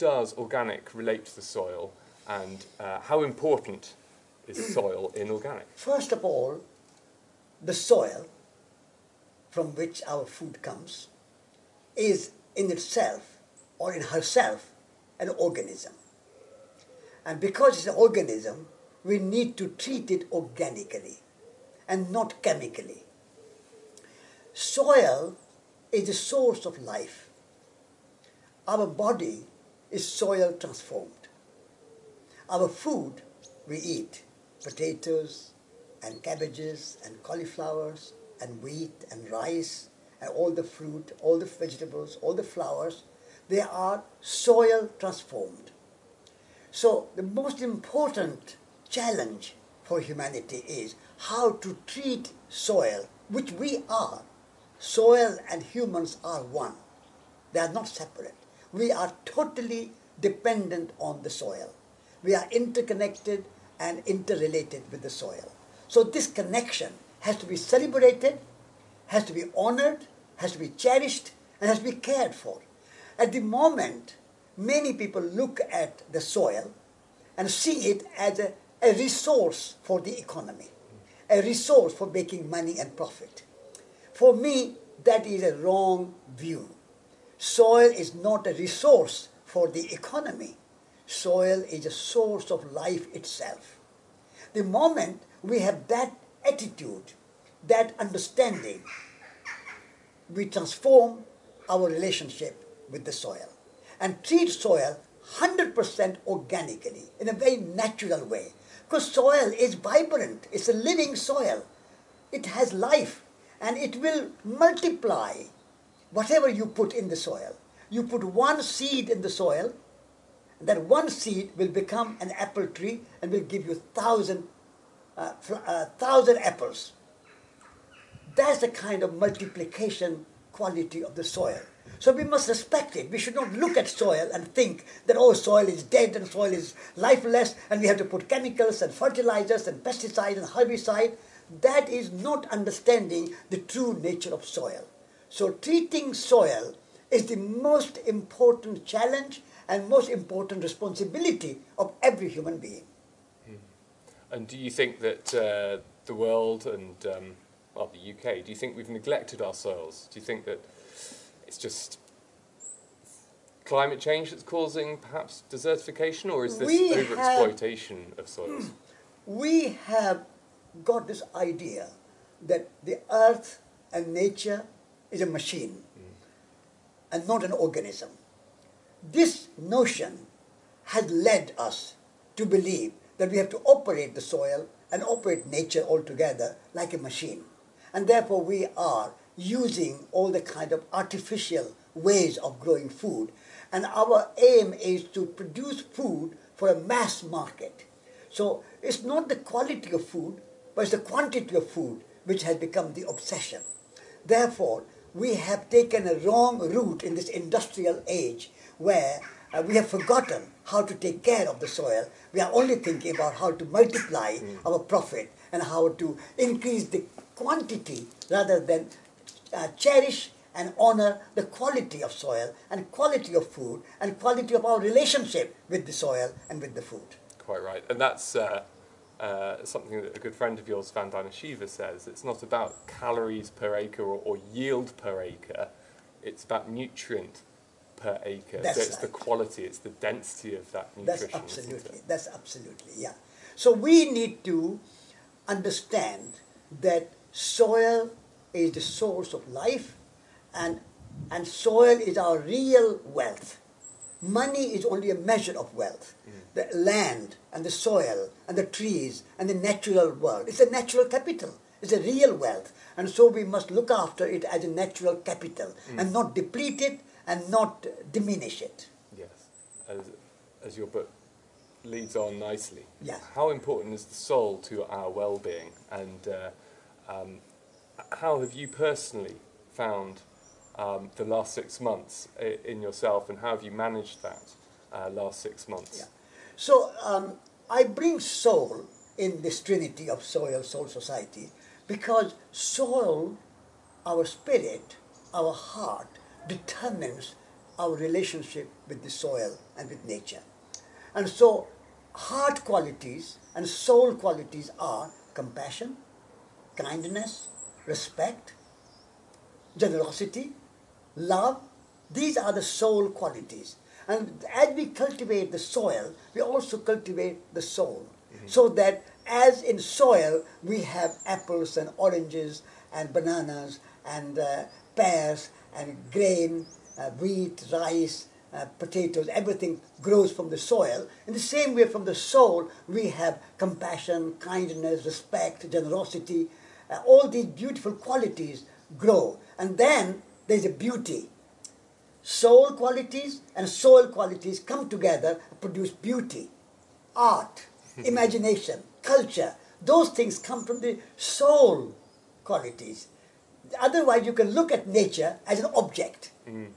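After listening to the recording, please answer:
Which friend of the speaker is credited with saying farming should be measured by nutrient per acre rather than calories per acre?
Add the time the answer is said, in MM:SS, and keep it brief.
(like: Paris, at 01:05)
Vandana Shiva, at 03:50.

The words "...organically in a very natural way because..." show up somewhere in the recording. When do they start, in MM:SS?
01:46.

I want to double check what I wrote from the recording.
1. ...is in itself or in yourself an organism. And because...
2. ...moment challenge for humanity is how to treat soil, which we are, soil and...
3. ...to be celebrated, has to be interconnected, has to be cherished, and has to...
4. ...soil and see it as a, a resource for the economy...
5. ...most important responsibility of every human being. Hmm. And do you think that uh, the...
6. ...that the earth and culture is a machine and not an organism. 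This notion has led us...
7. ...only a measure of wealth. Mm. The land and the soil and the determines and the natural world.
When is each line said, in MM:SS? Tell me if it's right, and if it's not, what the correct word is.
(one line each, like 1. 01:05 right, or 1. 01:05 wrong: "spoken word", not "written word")
1. 00:11 wrong: "herself", not "yourself"
2. 00:47 wrong: "important", not "moment"
3. 01:07 wrong: "honored", not "interconnected"
4. 01:16 right
5. 02:29 right
6. 02:52 wrong: "nature", not "culture"
7. 04:14 wrong: "trees", not "determines".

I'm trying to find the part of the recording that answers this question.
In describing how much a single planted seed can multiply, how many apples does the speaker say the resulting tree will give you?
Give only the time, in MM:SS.
02:05.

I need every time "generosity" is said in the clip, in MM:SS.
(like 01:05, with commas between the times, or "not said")
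05:09, 05:35.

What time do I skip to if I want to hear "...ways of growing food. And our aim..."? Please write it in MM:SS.
03:11.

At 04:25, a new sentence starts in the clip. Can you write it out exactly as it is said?
and not deplete it and not diminish it.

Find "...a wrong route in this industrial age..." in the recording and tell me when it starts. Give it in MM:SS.
03:26.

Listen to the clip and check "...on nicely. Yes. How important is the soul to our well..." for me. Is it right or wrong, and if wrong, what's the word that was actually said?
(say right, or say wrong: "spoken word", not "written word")
right.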